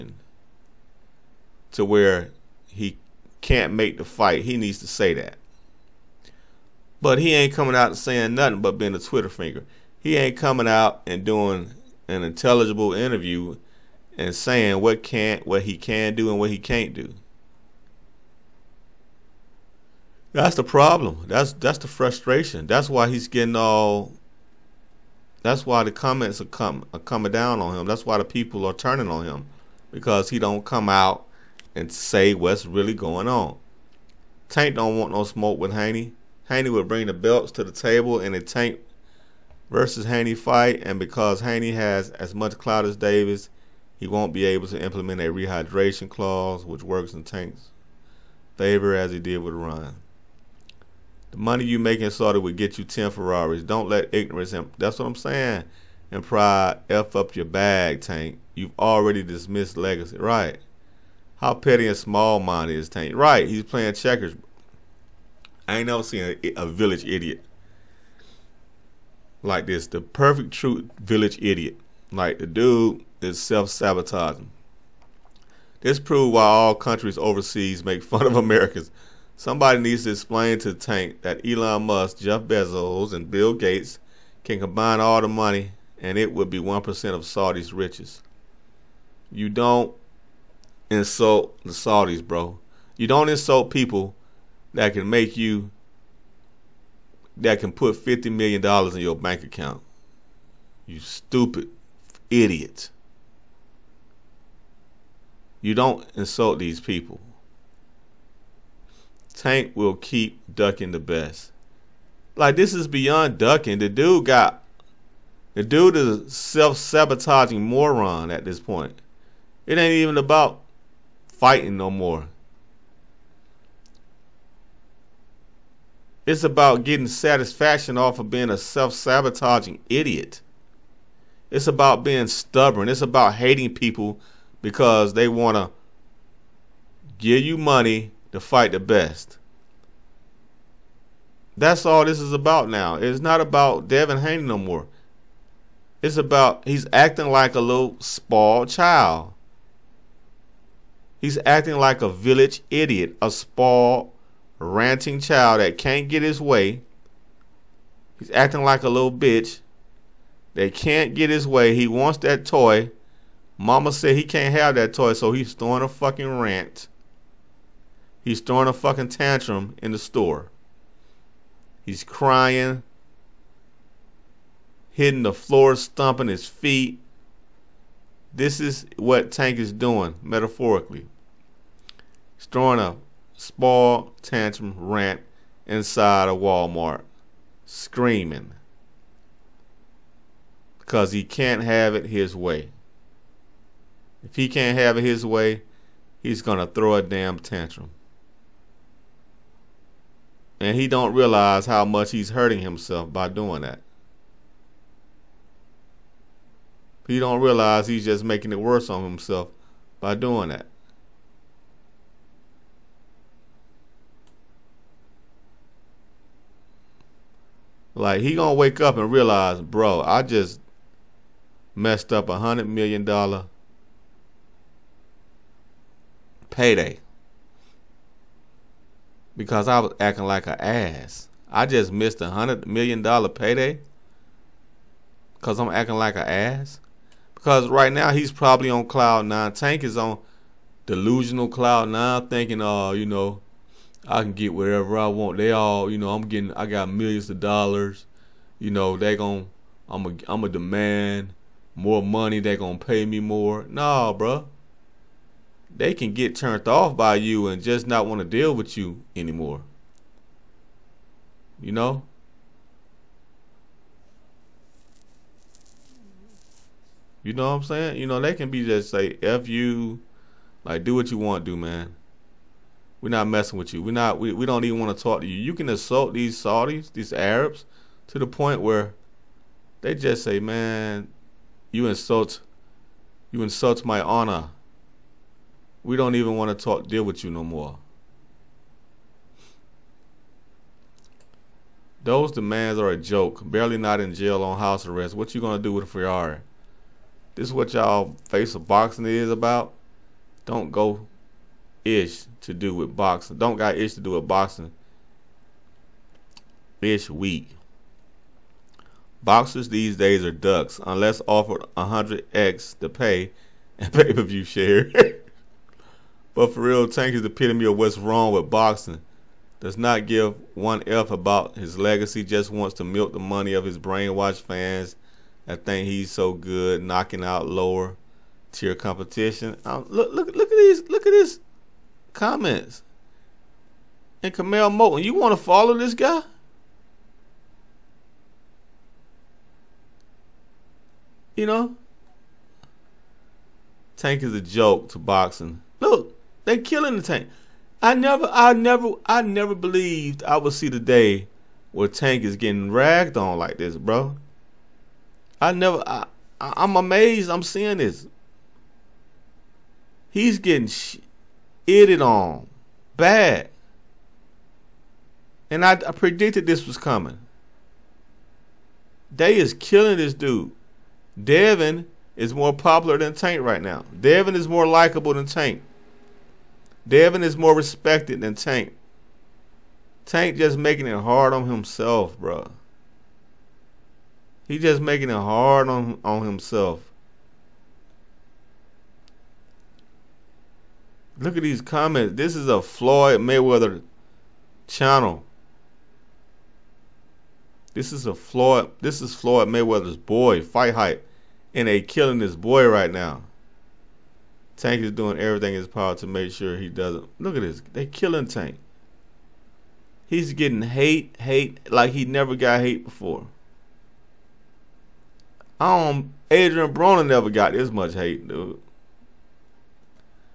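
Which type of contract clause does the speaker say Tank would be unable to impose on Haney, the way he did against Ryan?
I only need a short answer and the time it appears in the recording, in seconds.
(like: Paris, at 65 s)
Rehydration clause, at 45 s.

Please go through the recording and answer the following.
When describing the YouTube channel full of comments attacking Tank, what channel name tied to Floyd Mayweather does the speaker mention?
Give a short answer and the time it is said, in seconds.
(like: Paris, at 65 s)
Fight Hype, at 400 s.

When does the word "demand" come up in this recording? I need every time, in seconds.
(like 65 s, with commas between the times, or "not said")
250 s, 292 s.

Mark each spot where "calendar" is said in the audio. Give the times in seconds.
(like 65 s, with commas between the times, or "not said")
not said.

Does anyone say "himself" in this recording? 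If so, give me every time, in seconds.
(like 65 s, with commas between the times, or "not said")
202 s, 209 s, 381 s, 386 s.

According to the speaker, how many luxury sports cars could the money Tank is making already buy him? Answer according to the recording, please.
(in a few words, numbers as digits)
10 Ferraris.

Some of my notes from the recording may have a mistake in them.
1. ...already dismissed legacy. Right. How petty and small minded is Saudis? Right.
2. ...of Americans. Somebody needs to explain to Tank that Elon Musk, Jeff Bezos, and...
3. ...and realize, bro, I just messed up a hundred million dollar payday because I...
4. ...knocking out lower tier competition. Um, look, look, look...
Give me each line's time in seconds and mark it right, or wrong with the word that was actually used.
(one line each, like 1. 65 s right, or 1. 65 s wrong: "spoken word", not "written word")
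1. 58 s wrong: "Tank", not "Saudis"
2. 78 s right
3. 218 s right
4. 326 s right.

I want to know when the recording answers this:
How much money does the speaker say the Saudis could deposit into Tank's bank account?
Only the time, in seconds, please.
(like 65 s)
97 s.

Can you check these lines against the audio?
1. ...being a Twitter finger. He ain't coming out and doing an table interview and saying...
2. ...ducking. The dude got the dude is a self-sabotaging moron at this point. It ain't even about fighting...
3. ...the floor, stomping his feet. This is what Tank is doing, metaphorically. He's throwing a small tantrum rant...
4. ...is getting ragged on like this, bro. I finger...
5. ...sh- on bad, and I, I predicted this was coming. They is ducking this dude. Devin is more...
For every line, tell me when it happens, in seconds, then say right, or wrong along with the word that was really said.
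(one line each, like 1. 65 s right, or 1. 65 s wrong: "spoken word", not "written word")
1. 8 s wrong: "intelligible", not "table"
2. 113 s right
3. 175 s right
4. 352 s wrong: "never", not "finger"
5. 360 s wrong: "killing", not "ducking".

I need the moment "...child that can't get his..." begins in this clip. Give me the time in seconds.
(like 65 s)
155 s.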